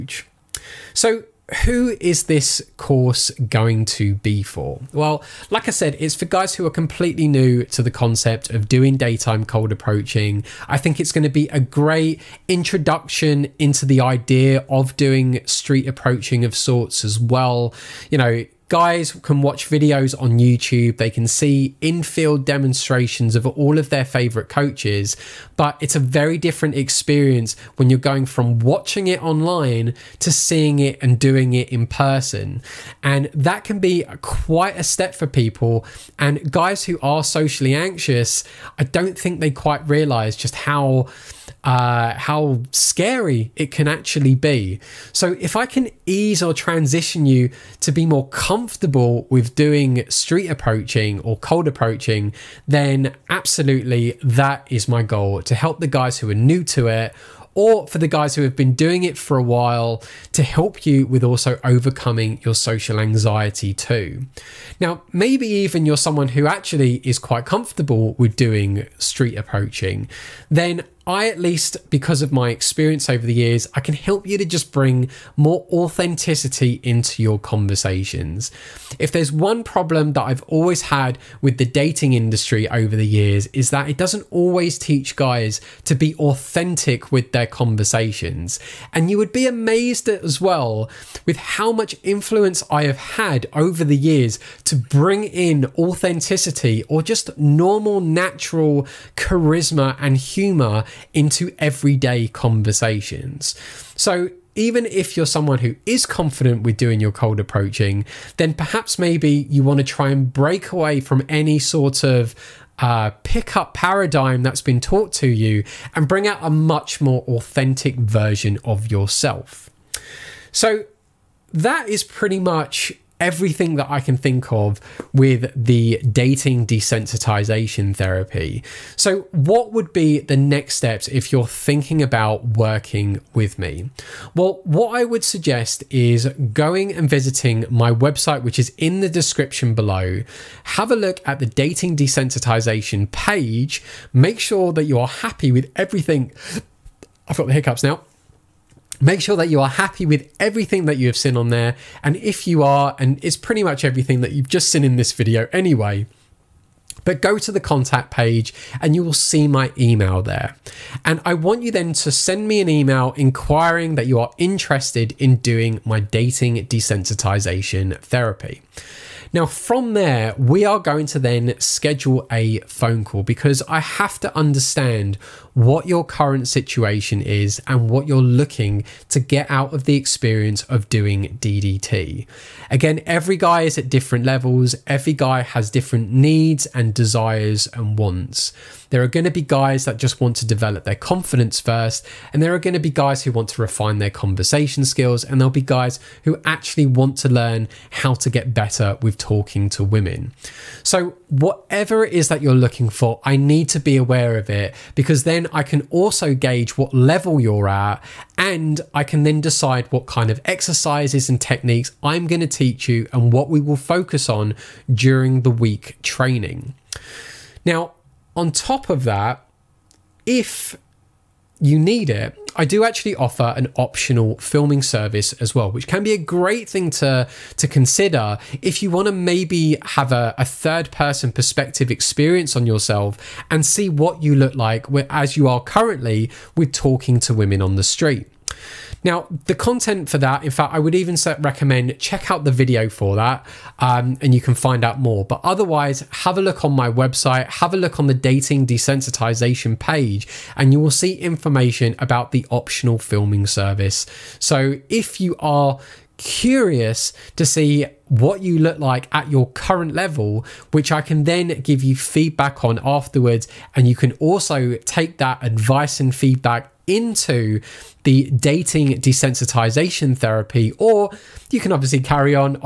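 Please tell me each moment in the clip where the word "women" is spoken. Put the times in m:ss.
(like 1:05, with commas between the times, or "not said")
3:19, 3:57.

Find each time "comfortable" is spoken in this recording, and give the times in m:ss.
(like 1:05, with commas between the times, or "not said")
0:48, 1:07.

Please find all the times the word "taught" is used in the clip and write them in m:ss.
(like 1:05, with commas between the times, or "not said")
1:54.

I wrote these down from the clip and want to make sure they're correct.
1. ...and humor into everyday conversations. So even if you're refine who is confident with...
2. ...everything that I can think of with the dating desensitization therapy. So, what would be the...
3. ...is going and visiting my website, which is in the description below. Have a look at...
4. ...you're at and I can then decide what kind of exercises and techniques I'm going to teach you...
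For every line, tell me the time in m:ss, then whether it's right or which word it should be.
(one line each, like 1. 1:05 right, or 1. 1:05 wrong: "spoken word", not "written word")
1. 1:39 wrong: "someone", not "refine"
2. 2:03 right
3. 2:15 right
4. 3:27 right.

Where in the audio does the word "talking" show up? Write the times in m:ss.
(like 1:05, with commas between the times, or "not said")
3:19, 3:56.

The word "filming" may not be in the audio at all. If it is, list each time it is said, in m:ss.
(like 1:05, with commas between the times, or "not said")
3:44, 4:12.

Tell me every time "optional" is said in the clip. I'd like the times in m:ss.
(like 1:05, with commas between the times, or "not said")
3:43, 4:12.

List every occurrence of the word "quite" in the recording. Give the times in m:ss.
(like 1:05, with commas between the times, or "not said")
0:34, 0:39, 1:07.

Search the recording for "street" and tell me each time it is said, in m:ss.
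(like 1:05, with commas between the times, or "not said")
0:15, 0:50, 1:08, 3:57.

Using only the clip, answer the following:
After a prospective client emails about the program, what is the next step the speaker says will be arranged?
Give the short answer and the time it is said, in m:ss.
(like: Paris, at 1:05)
a phone call, at 2:52.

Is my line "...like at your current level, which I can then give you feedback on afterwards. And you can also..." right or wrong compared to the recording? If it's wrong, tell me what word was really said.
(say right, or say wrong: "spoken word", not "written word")
right.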